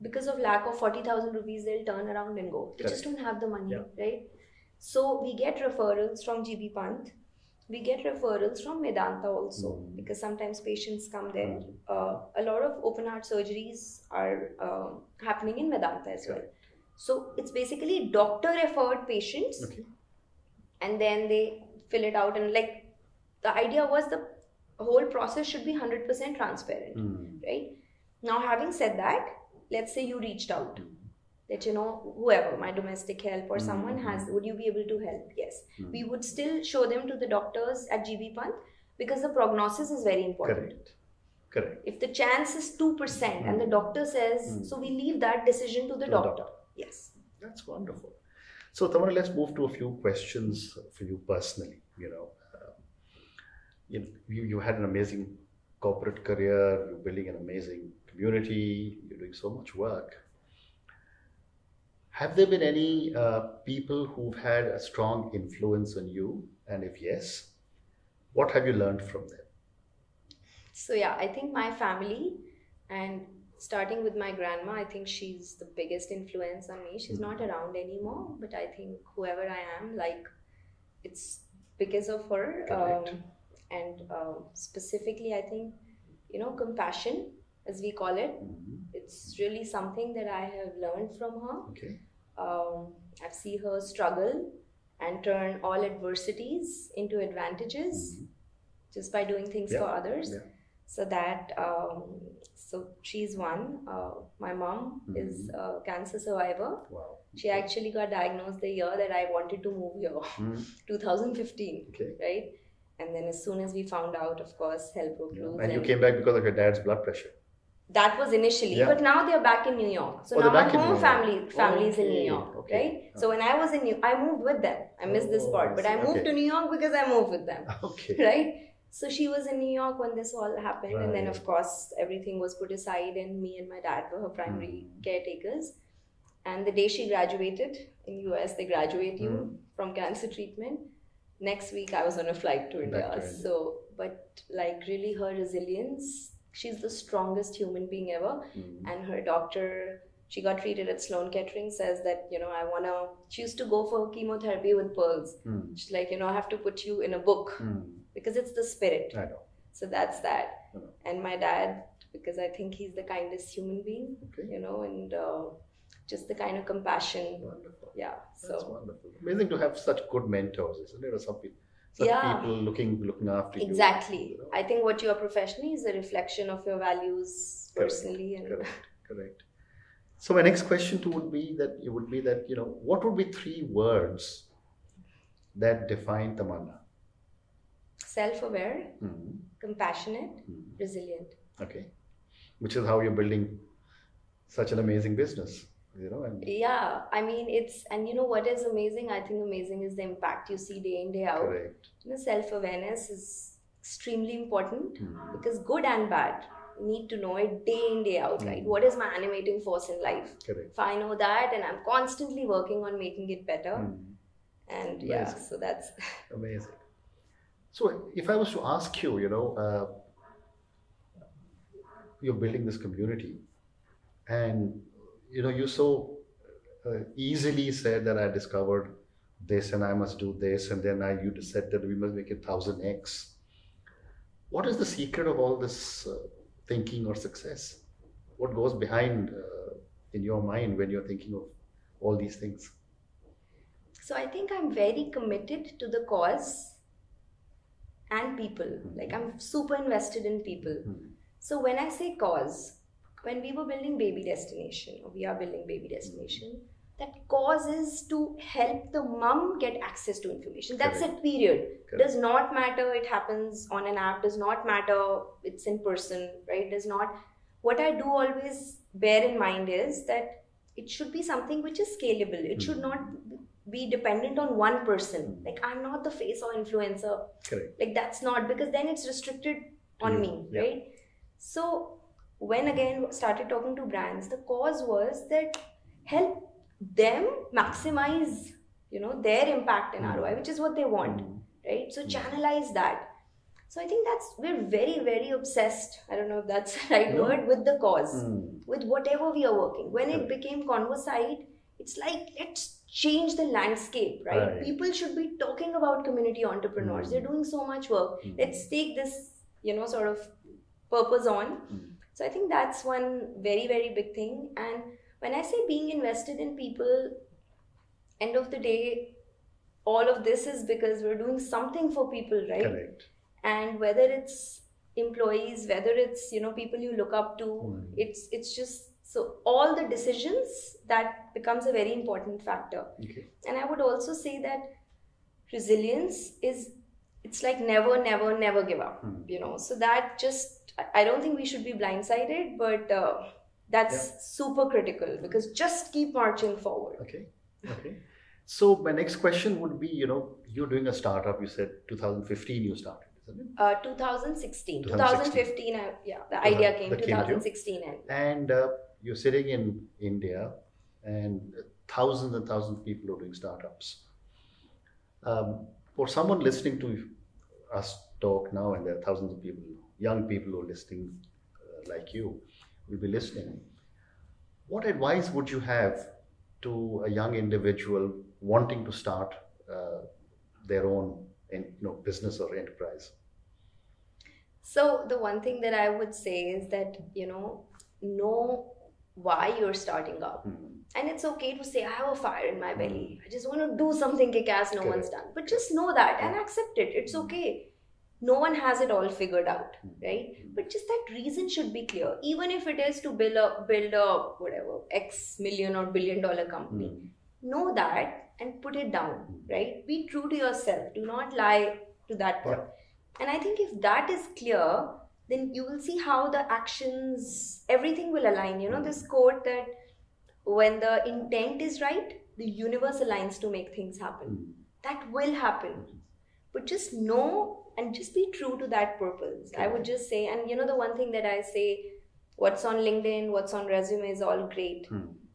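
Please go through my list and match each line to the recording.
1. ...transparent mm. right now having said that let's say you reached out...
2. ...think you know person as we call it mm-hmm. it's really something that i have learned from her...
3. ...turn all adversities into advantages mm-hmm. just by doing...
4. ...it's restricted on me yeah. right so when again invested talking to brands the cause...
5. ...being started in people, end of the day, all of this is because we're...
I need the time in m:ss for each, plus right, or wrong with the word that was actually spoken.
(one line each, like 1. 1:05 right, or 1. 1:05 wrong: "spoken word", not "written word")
1. 0:26 right
2. 1:25 wrong: "compassion", not "person"
3. 1:35 right
4. 4:38 wrong: "started", not "invested"
5. 5:15 wrong: "invested", not "started".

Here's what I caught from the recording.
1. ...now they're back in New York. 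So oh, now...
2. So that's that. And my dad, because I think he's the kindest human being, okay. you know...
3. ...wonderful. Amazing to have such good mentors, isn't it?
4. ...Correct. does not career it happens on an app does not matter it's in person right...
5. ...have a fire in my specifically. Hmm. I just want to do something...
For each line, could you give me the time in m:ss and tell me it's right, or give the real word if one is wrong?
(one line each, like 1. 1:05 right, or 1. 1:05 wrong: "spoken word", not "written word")
1. 1:59 right
2. 2:39 right
3. 2:48 right
4. 4:21 wrong: "matter", not "career"
5. 6:31 wrong: "belly", not "specifically".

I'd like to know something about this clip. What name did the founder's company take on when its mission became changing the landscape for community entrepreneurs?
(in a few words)
Convosight.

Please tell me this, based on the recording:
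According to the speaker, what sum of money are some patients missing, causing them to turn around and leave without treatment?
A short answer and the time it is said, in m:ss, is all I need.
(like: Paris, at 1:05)
40,000 rupees, at 0:00.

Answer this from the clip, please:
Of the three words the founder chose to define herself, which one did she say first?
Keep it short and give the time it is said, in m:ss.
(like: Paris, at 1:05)
Self-aware, at 3:07.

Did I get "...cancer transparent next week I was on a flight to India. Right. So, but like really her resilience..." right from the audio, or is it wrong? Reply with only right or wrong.
wrong.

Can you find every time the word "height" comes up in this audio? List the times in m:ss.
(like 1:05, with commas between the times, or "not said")
not said.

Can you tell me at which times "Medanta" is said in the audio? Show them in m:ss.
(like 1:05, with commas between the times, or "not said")
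0:08, 0:15.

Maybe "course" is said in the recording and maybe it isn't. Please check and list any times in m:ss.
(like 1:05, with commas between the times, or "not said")
1:54, 2:11.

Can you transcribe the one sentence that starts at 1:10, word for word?
So, yeah, I think my family and starting with my grandma, I think she's the biggest influence on me.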